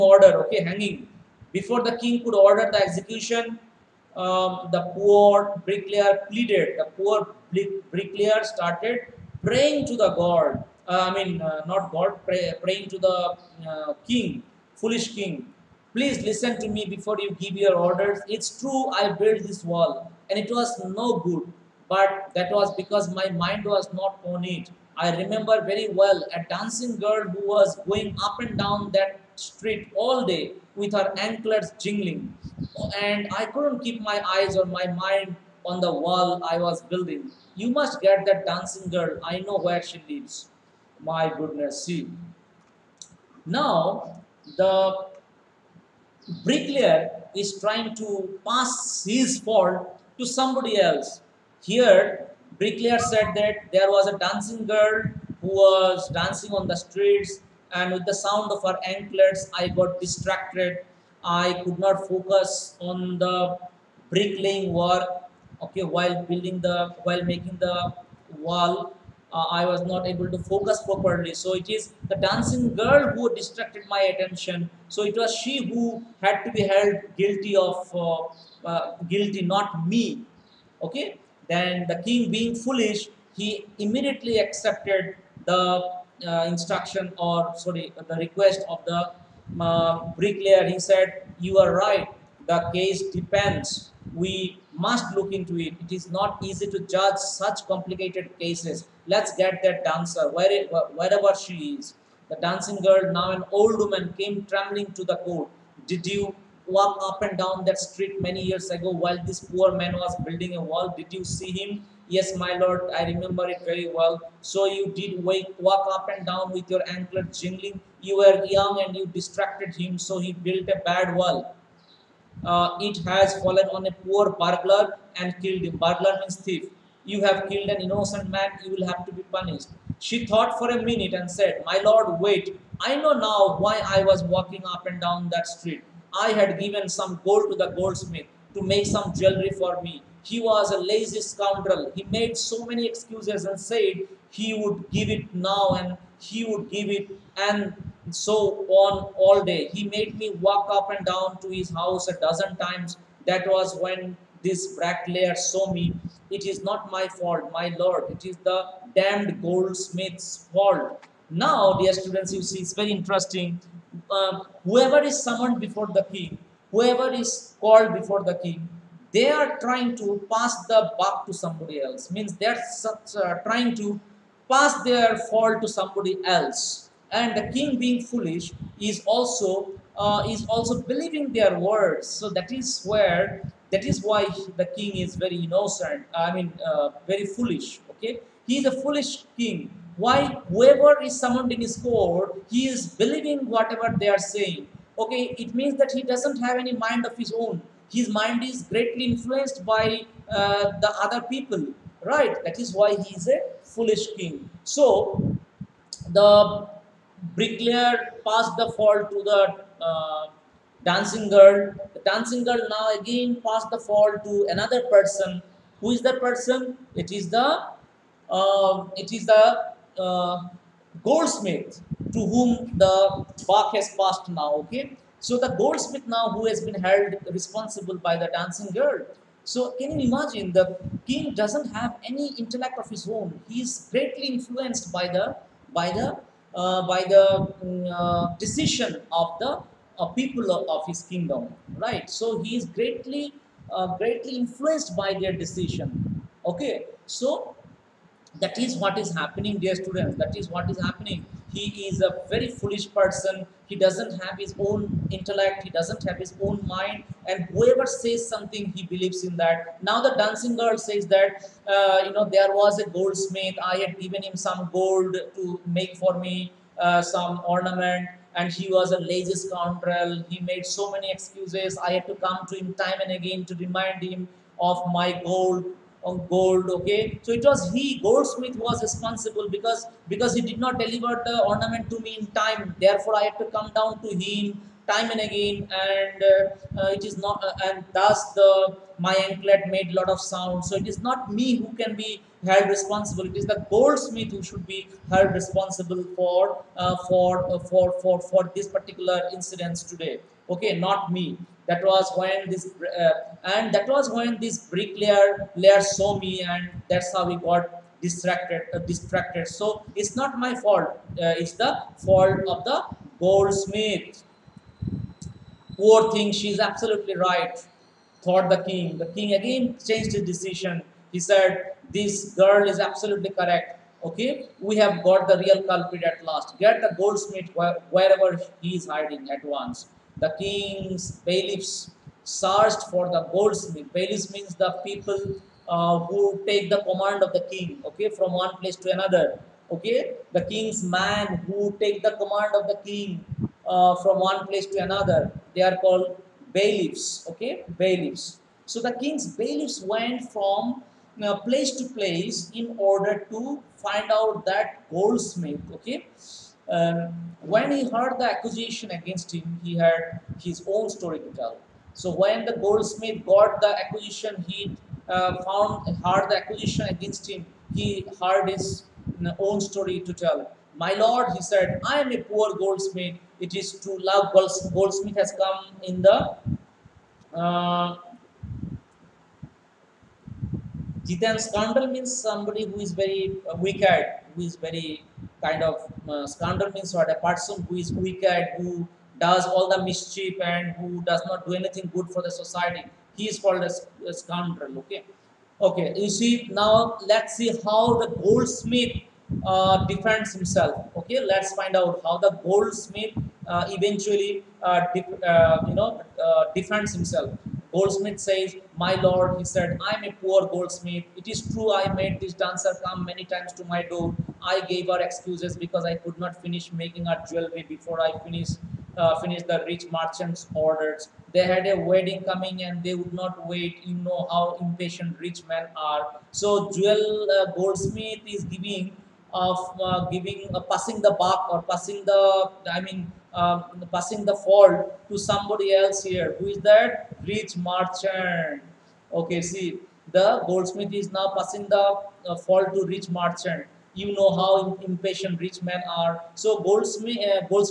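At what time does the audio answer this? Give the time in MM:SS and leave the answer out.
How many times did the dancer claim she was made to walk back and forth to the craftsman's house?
02:32.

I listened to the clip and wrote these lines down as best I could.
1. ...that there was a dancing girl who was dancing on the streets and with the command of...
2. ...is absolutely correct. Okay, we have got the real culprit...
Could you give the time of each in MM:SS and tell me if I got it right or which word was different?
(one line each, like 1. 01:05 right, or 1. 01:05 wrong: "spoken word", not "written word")
1. 00:53 wrong: "sound", not "command"
2. 05:22 right.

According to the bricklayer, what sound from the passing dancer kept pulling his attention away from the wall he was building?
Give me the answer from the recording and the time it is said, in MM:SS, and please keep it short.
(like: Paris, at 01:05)
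anklets jingling, at 00:31.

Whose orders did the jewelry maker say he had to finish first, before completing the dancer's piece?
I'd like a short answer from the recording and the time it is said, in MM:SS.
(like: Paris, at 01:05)
the rich merchant's, at 06:59.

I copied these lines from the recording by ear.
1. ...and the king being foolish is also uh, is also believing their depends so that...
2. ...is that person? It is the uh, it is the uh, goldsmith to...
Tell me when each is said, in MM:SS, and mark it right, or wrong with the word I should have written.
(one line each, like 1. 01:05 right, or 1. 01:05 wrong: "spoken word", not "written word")
1. 02:57 wrong: "words", not "depends"
2. 03:35 right.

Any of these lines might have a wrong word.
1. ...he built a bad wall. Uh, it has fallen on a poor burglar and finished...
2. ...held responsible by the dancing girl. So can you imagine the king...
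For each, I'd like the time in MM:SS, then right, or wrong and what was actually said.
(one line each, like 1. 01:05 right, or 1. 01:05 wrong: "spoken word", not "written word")
1. 02:00 wrong: "killed", not "finished"
2. 03:46 right.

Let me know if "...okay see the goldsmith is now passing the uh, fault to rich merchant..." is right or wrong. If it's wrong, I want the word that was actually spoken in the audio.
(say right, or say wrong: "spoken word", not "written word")
right.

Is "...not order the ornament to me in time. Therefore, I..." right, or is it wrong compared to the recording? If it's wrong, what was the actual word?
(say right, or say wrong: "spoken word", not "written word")
wrong: "deliver", not "order".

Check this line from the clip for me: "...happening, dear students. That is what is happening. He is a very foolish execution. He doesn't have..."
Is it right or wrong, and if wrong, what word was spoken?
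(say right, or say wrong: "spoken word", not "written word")
wrong: "person", not "execution".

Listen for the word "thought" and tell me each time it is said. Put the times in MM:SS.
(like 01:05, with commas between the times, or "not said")
02:10, 05:18.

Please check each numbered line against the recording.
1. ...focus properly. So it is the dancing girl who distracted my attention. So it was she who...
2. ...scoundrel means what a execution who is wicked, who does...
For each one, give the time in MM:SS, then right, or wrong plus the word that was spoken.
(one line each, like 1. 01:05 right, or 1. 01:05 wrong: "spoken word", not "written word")
1. 01:10 right
2. 06:26 wrong: "person", not "execution".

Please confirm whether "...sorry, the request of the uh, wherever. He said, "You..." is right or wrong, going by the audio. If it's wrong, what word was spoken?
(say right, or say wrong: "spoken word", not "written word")
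wrong: "bricklayer", not "wherever".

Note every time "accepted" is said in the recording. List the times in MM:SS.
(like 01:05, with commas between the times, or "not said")
01:24.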